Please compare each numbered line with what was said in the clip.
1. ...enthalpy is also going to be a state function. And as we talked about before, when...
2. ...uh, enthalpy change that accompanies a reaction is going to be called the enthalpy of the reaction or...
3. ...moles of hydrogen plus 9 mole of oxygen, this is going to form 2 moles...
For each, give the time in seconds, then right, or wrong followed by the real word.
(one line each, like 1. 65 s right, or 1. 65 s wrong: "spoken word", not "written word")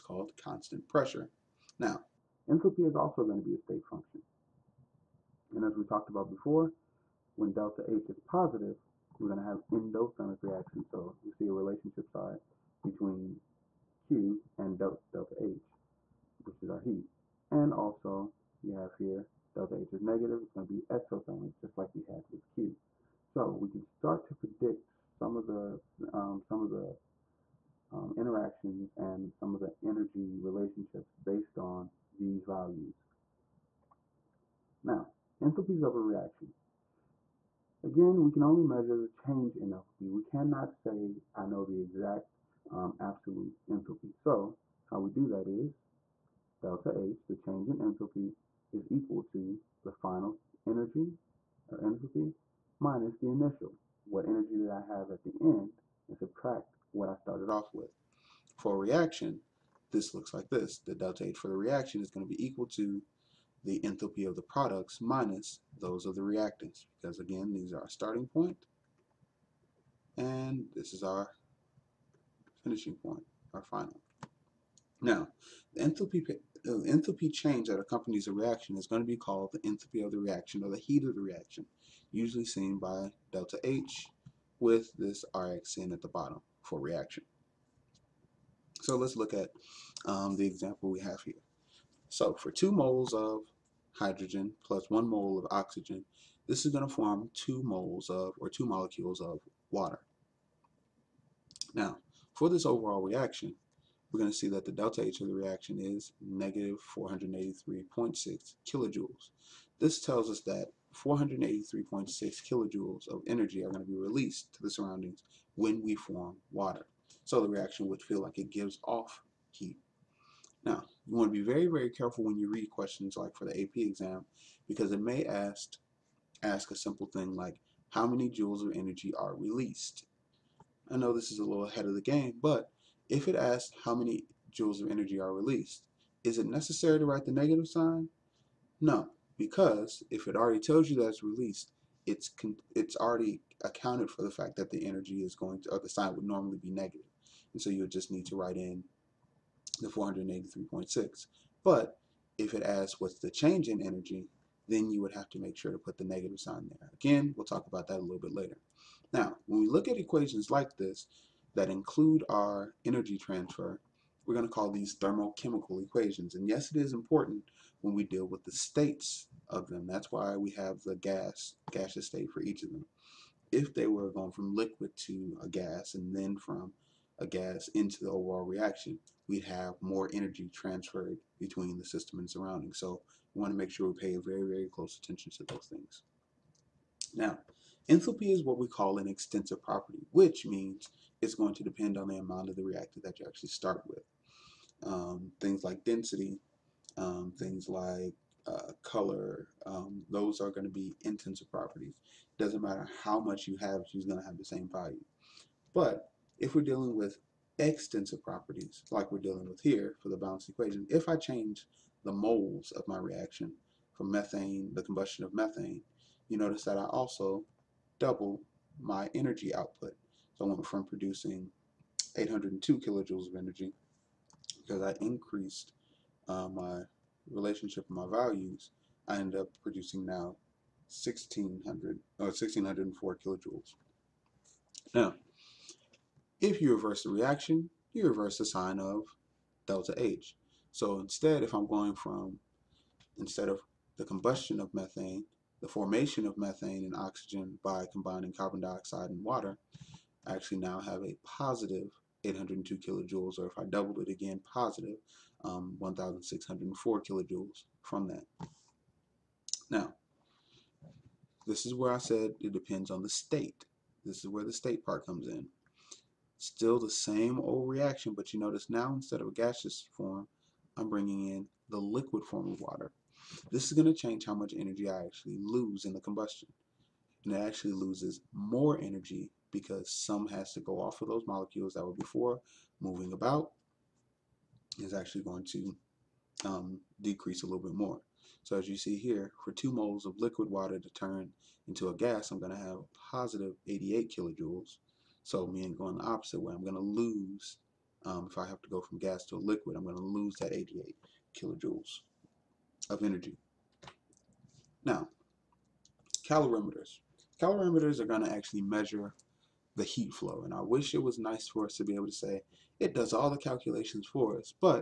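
1. 2 s right
2. 76 s right
3. 92 s wrong: "1", not "9".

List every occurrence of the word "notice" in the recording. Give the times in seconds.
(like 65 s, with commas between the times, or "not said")
216 s, 268 s.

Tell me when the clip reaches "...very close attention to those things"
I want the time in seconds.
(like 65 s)
184 s.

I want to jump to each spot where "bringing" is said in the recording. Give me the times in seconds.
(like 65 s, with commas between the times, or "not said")
270 s.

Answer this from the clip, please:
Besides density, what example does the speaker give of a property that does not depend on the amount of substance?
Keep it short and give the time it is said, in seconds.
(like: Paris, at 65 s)
color, at 198 s.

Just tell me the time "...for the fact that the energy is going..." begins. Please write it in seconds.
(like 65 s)
144 s.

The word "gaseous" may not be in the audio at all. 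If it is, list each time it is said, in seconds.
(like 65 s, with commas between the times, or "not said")
171 s, 269 s.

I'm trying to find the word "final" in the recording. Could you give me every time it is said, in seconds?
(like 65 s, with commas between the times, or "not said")
49 s, 73 s.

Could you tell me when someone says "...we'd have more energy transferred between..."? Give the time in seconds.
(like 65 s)
179 s.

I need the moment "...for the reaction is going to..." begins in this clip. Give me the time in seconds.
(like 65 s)
61 s.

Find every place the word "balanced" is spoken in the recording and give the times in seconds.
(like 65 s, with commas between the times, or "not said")
210 s.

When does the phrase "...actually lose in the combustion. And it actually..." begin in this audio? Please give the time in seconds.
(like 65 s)
275 s.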